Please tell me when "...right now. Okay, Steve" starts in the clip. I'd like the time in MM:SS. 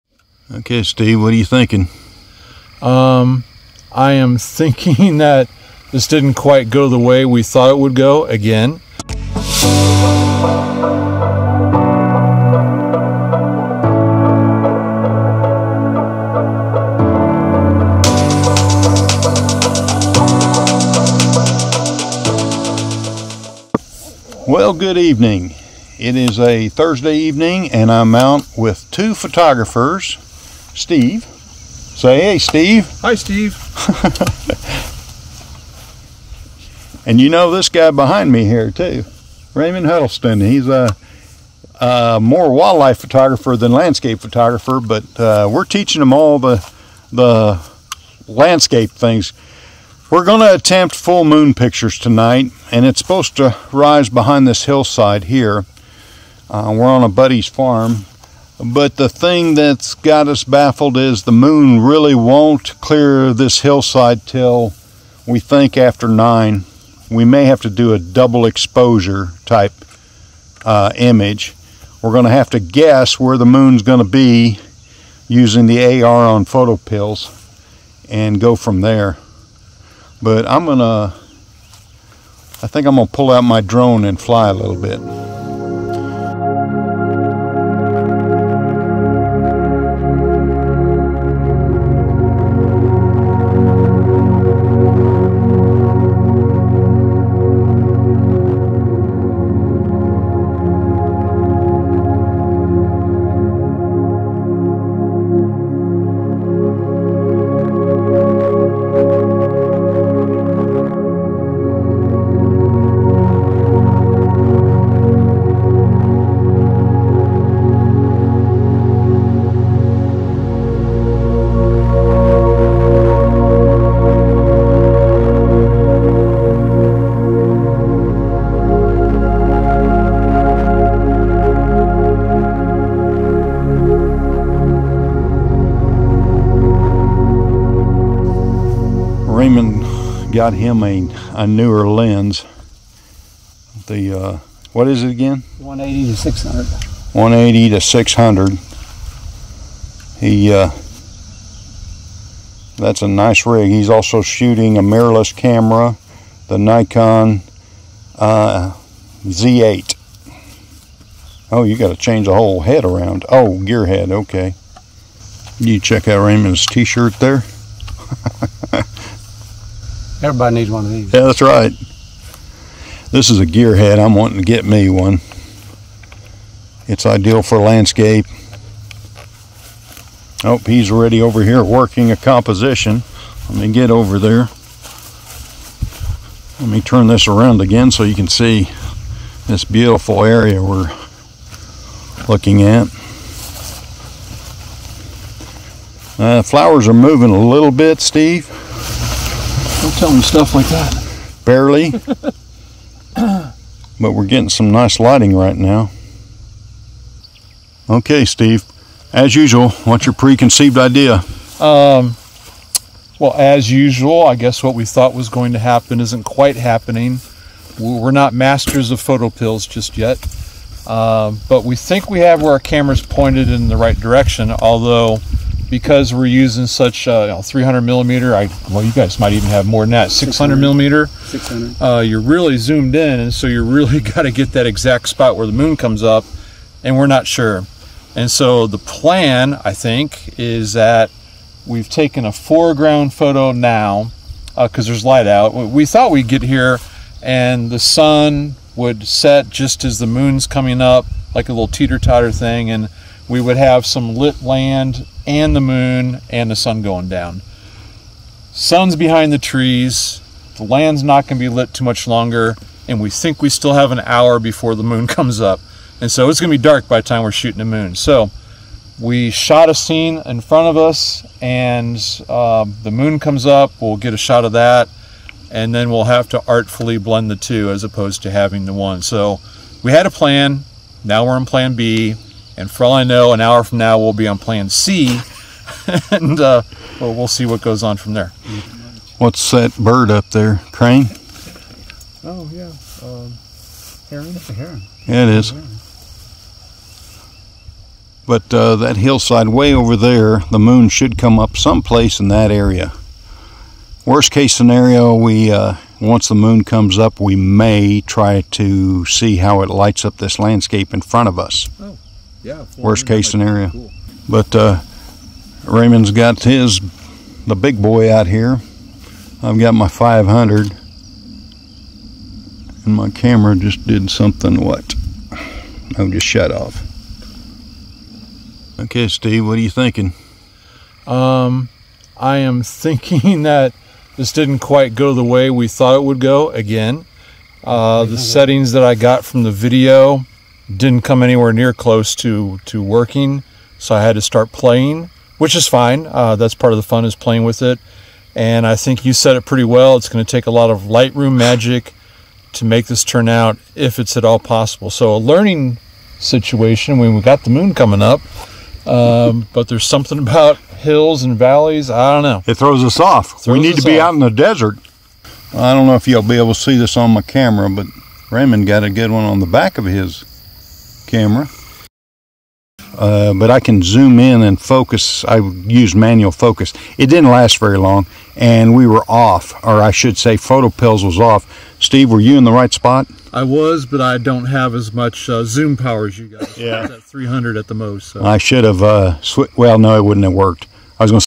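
03:25.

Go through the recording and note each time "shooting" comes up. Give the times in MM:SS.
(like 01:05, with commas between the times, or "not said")
02:34, 04:27.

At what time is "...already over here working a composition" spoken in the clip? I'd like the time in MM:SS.
03:00.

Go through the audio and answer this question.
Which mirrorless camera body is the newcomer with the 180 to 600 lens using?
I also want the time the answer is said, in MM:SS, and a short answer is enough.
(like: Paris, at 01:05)
Nikon Z8, at 02:36.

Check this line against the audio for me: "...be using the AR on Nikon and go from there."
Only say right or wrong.
wrong.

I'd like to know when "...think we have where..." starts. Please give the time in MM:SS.
03:41.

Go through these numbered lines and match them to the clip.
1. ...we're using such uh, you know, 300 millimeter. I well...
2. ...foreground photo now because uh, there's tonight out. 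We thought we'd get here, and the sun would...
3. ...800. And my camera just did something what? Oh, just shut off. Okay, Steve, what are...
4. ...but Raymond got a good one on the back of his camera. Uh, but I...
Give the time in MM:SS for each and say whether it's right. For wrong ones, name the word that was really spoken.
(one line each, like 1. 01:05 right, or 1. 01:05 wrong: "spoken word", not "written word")
1. 03:46 right
2. 04:02 wrong: "light", not "tonight"
3. 05:19 wrong: "500", not "800"
4. 06:07 right.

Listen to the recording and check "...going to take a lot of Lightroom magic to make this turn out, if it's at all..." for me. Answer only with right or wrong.
right.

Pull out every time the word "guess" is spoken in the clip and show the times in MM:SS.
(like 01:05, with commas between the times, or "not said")
01:12, 03:34.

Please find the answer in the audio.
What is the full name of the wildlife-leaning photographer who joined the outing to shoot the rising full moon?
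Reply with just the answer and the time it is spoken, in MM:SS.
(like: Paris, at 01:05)
Raymond Huddleston, at 00:39.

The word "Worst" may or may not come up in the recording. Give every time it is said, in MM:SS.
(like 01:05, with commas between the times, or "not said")
05:04, 05:12.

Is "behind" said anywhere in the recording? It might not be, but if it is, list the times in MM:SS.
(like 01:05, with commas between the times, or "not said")
00:37, 00:54, 04:18.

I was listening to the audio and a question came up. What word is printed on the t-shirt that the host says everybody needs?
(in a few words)
gearhead.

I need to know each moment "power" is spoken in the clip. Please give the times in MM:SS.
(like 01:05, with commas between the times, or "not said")
06:25.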